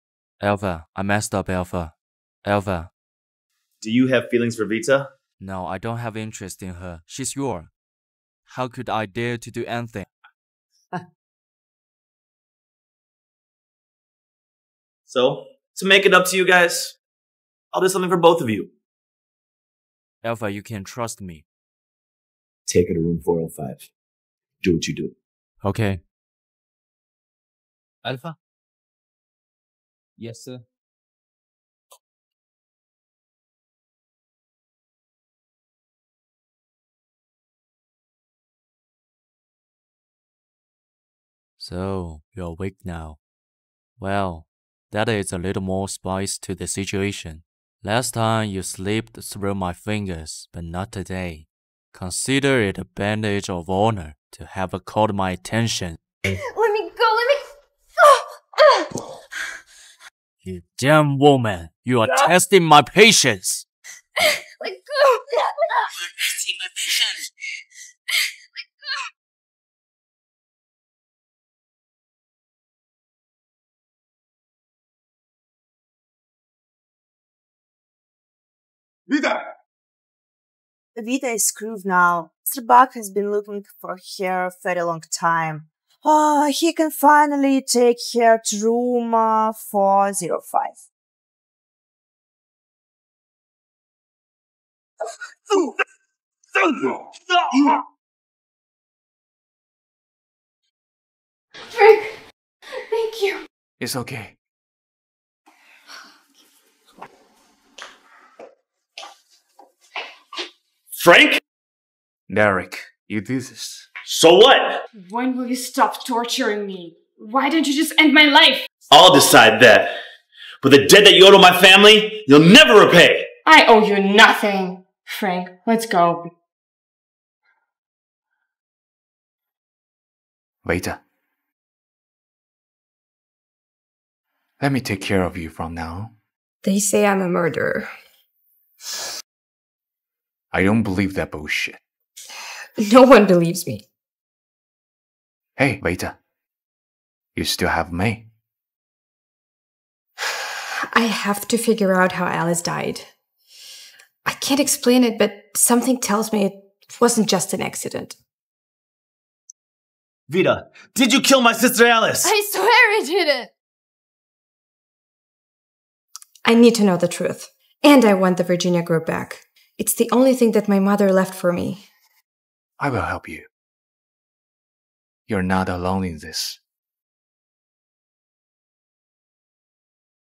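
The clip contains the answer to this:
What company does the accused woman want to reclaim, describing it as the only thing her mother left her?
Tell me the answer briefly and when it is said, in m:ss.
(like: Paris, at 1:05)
Virginia Group, at 2:48.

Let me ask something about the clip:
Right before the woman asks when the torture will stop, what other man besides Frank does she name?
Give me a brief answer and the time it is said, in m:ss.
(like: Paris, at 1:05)
Derek, at 1:52.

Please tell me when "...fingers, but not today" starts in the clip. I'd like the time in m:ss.
0:49.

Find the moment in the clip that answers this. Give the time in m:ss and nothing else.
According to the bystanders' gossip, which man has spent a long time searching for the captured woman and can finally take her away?
1:22.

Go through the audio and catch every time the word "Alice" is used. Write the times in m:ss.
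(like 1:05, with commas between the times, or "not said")
2:32, 2:41.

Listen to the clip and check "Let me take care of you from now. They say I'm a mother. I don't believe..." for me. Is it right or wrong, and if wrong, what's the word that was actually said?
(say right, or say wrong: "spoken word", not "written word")
wrong: "murderer", not "mother".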